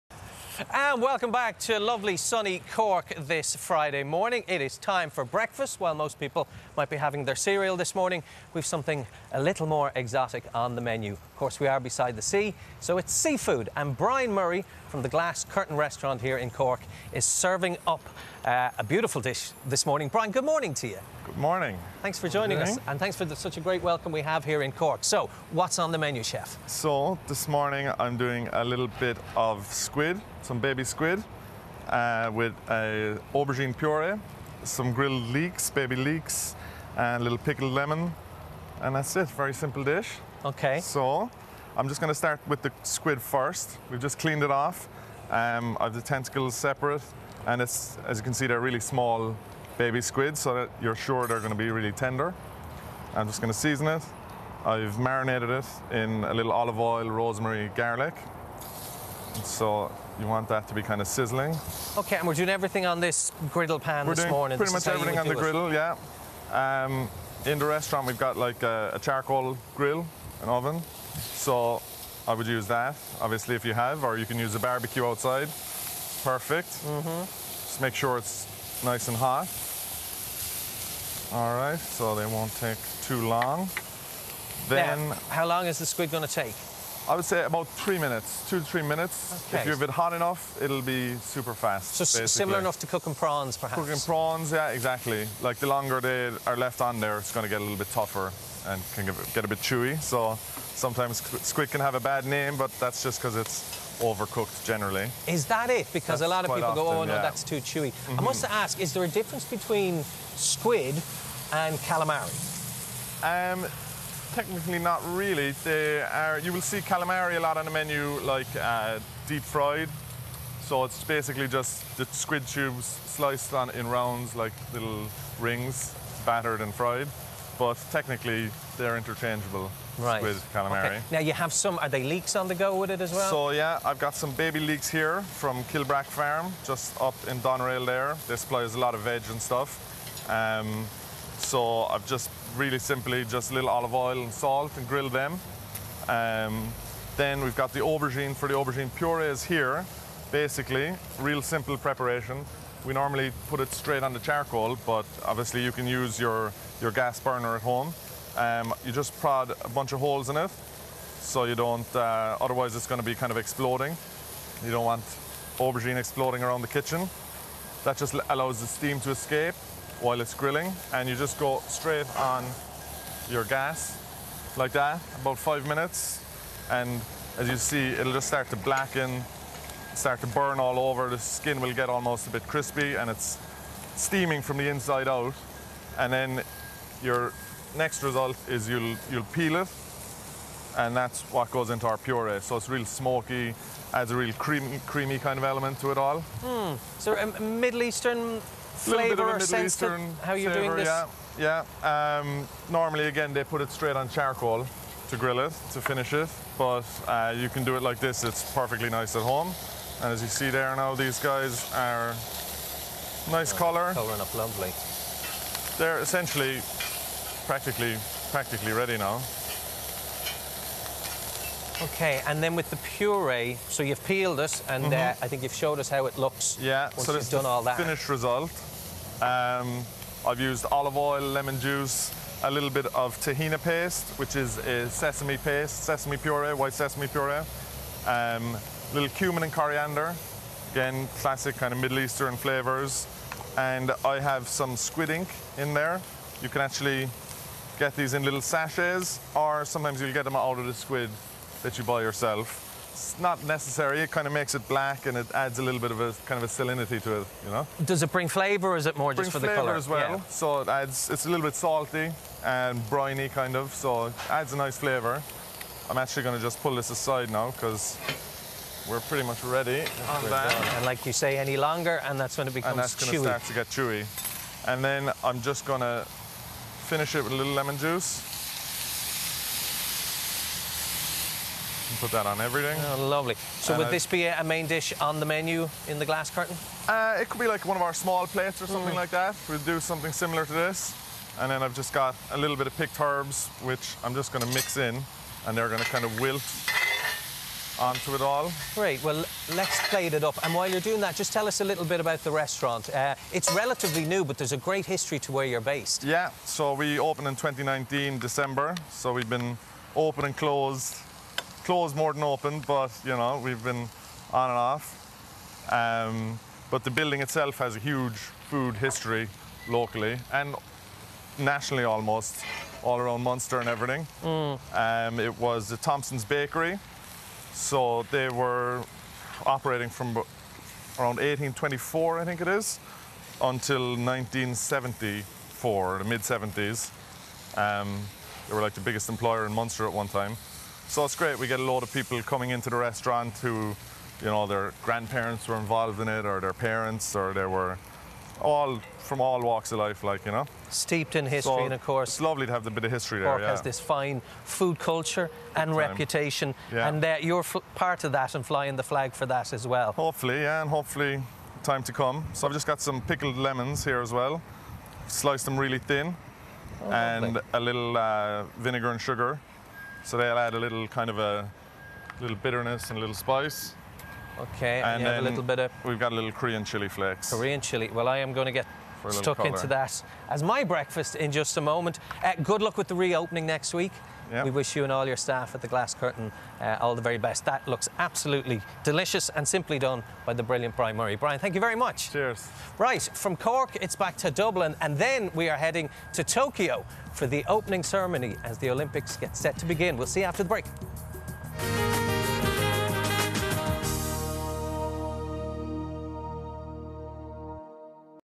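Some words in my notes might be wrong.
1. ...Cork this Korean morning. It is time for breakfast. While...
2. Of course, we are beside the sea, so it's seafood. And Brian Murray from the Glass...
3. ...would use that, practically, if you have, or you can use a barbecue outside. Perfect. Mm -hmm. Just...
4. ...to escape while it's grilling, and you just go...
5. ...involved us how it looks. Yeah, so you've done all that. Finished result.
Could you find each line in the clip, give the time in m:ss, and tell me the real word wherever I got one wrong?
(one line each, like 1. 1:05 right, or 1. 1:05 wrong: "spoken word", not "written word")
1. 0:02 wrong: "Friday", not "Korean"
2. 0:11 right
3. 1:12 wrong: "obviously", not "practically"
4. 2:49 right
5. 3:45 wrong: "showed", not "involved".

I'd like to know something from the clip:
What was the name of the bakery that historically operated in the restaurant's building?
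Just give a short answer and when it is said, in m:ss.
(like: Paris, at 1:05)
Thompson's Bakery, at 5:25.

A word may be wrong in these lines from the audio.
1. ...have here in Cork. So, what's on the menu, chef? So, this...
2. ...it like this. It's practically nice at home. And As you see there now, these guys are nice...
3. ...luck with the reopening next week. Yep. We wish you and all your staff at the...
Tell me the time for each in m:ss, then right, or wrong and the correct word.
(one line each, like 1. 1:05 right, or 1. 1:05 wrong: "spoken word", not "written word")
1. 0:24 right
2. 3:27 wrong: "perfectly", not "practically"
3. 6:22 right.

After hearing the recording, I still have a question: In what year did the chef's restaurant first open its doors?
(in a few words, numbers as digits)
2019.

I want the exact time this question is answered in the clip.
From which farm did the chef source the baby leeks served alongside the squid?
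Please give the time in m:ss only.
2:15.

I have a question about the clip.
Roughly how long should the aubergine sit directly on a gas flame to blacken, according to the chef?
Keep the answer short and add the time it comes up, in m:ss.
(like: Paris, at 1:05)
about 5 minutes, at 2:55.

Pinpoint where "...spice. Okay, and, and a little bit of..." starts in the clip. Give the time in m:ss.
6:13.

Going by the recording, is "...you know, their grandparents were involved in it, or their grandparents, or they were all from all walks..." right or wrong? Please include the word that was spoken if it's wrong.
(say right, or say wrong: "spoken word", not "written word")
wrong: "parents", not "grandparents".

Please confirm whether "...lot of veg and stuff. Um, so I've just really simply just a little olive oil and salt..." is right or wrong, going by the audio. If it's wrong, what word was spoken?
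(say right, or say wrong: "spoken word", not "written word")
right.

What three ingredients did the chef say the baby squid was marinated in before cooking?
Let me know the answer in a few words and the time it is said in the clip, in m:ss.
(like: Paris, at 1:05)
olive oil, rosemary, garlic, at 0:56.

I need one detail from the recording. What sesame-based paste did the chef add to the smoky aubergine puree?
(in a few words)
tahina paste.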